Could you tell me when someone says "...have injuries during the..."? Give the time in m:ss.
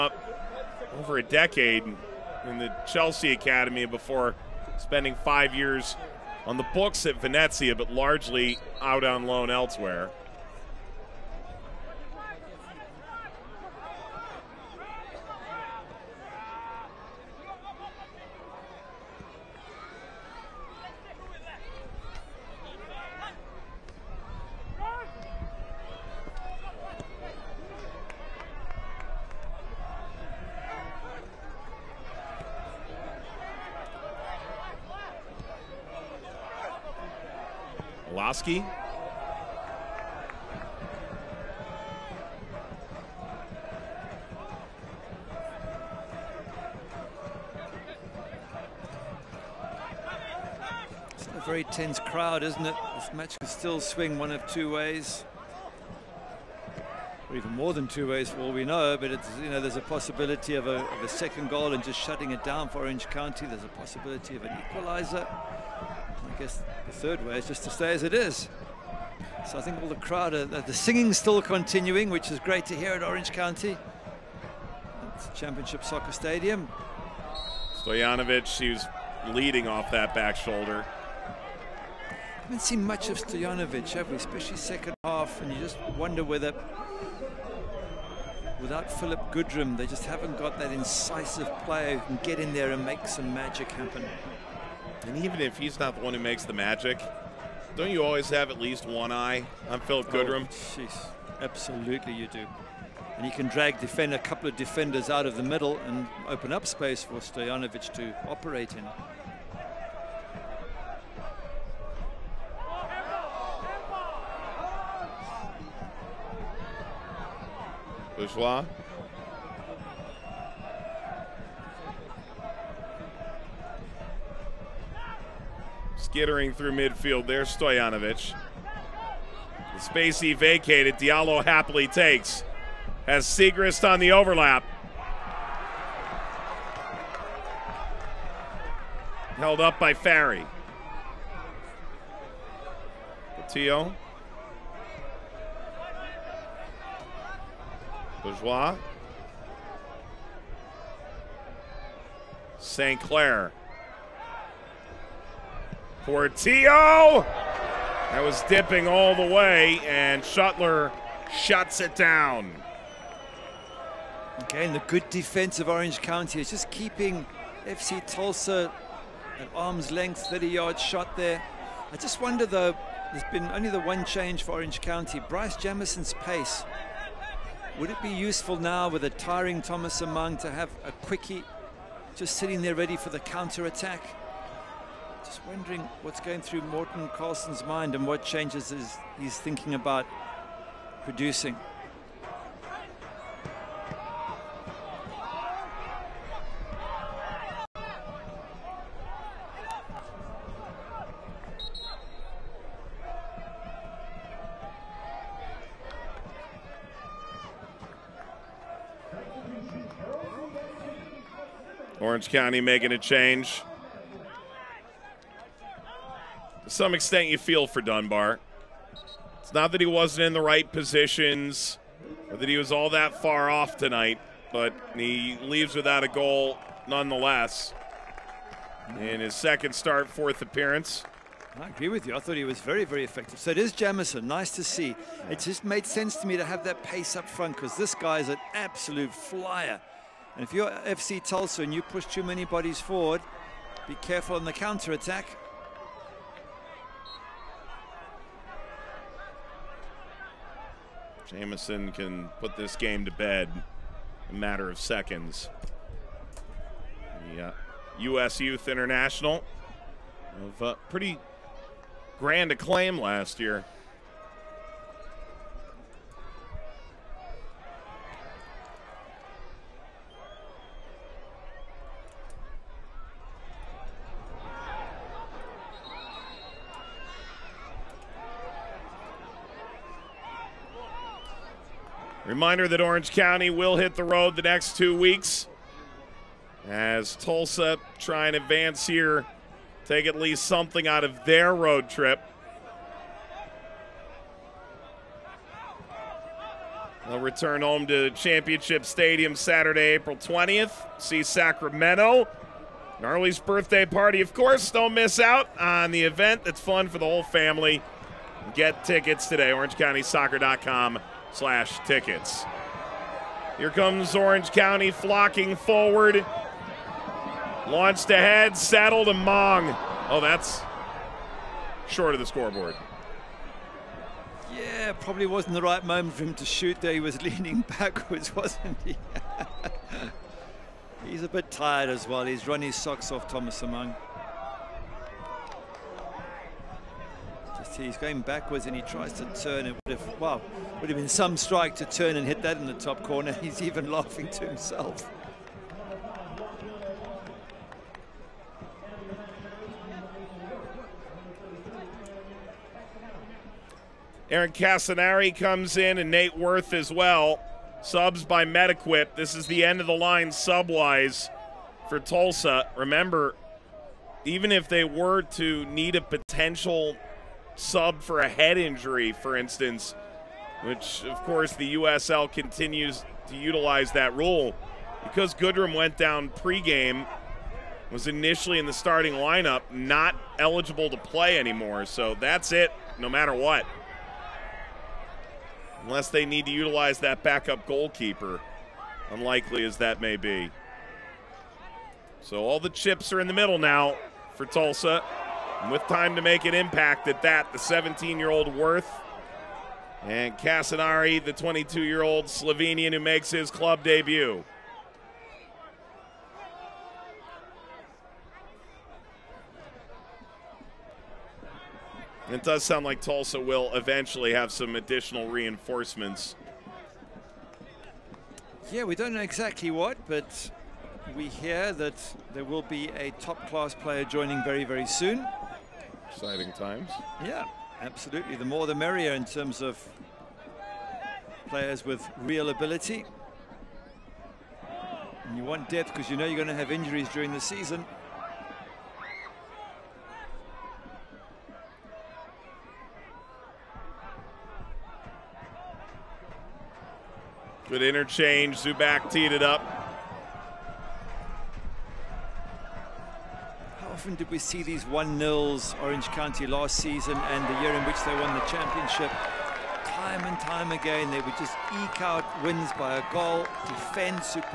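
7:16.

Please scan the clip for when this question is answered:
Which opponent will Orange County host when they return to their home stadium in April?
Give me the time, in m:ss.
5:01.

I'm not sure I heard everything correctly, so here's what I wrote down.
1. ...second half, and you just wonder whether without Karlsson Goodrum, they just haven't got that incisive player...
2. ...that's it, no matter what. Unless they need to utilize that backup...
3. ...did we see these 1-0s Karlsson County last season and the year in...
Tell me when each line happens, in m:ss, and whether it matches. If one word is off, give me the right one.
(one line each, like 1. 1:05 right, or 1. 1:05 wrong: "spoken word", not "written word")
1. 1:24 wrong: "Phillip", not "Karlsson"
2. 6:22 right
3. 7:34 wrong: "Orange", not "Karlsson".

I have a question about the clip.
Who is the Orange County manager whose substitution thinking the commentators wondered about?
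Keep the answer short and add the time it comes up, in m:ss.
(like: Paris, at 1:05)
Morten Karlsson, at 3:06.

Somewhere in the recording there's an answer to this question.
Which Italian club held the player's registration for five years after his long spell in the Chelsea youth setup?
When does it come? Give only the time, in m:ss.
0:07.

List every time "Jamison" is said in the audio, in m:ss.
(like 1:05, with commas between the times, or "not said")
2:55, 3:53, 4:11.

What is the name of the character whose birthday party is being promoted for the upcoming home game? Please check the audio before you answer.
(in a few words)
Gnarly.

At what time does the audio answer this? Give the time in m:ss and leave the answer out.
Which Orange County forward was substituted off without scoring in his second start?
3:37.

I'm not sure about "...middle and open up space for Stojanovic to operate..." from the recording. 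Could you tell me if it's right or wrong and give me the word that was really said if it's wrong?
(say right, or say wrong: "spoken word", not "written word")
right.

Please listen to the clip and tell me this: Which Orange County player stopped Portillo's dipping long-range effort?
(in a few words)
Shutler.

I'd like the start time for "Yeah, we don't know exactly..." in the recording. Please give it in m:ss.
6:58.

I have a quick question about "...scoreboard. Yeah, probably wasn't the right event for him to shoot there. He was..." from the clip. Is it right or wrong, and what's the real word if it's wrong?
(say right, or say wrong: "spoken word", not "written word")
wrong: "moment", not "event".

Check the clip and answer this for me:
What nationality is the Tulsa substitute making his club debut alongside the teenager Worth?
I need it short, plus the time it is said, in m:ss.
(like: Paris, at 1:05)
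Slovenian, at 6:42.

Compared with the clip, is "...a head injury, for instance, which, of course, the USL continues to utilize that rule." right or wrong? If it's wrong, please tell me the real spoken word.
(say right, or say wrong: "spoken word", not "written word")
right.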